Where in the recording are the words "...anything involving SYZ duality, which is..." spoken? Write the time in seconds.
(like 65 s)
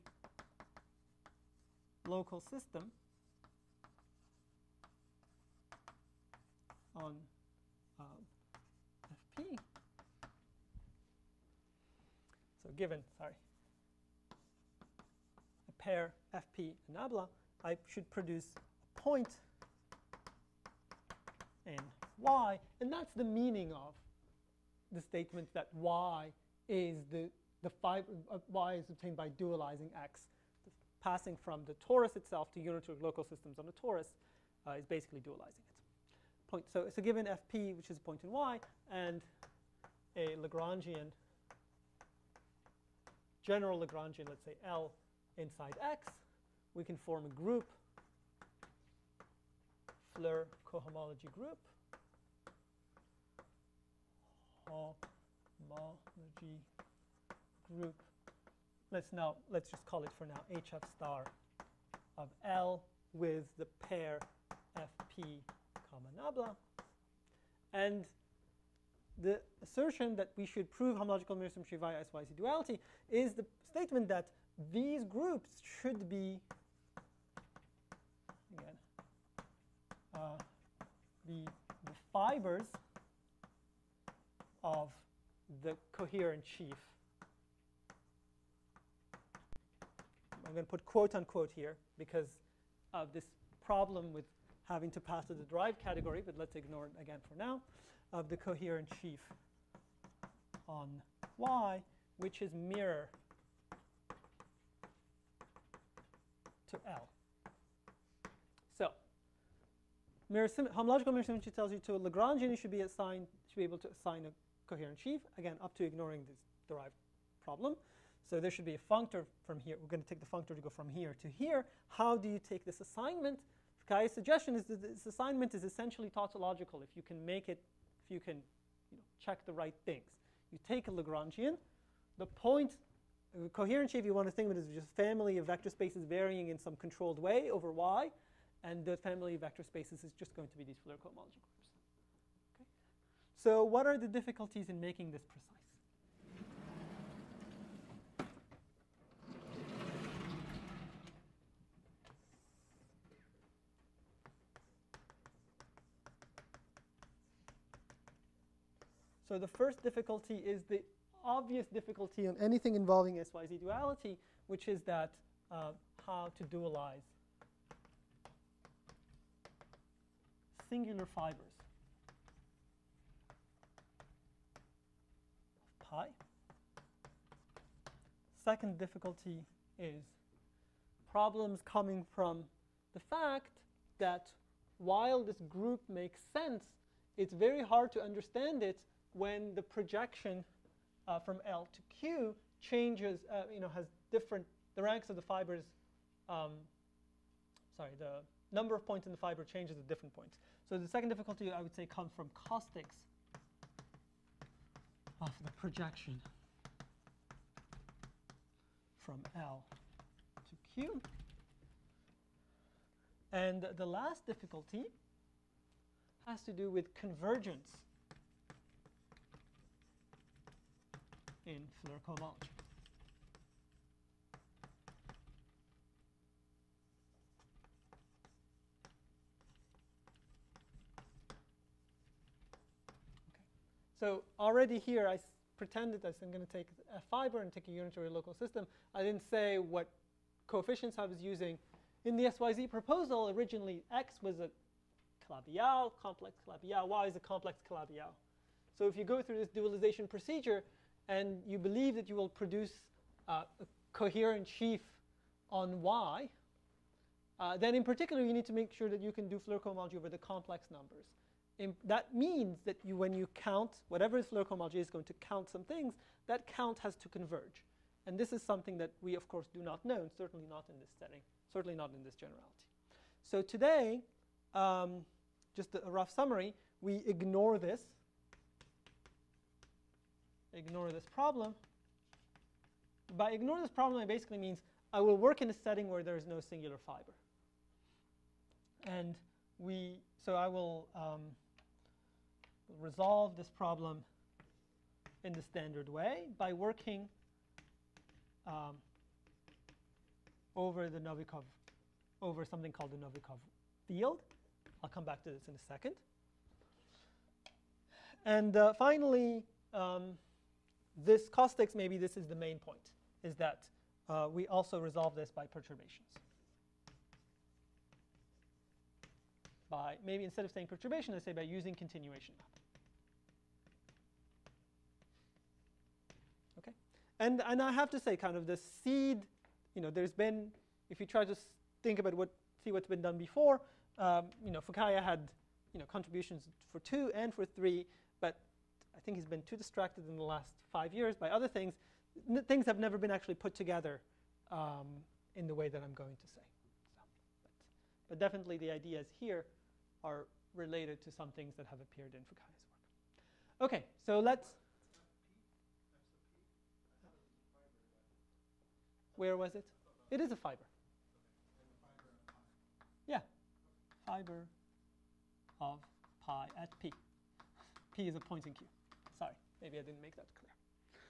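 162 s.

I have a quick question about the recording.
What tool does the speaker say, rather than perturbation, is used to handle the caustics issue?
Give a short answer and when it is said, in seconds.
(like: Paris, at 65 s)
Continuation map, at 321 s.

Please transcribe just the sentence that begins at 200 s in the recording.
So the second difficulty, I would say, comes from caustics of ah, the projection from L to Q.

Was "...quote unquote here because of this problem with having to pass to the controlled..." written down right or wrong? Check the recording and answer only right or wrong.
wrong.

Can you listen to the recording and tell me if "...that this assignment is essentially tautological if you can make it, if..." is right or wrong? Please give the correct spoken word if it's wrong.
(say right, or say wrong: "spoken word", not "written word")
right.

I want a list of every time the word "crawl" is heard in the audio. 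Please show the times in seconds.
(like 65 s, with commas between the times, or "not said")
not said.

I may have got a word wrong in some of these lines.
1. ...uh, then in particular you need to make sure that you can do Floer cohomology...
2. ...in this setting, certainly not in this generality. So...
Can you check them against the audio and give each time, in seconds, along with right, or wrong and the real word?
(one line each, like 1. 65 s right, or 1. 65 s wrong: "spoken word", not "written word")
1. 257 s right
2. 270 s right.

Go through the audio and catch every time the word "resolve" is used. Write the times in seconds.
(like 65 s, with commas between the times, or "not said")
292 s, 314 s.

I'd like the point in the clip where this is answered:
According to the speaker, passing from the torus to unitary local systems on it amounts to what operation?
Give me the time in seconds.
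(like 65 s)
35 s.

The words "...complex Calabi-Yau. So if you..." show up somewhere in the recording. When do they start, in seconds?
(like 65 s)
247 s.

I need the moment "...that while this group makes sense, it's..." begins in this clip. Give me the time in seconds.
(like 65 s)
183 s.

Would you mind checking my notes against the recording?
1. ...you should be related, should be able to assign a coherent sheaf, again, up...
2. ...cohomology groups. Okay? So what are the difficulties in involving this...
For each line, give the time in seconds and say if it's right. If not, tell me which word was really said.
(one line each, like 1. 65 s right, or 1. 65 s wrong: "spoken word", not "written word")
1. 112 s wrong: "assigned", not "related"
2. 140 s wrong: "making", not "involving".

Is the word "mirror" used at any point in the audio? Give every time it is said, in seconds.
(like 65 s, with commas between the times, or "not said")
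71 s, 102 s, 111 s.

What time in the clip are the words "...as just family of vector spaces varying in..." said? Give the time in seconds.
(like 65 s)
134 s.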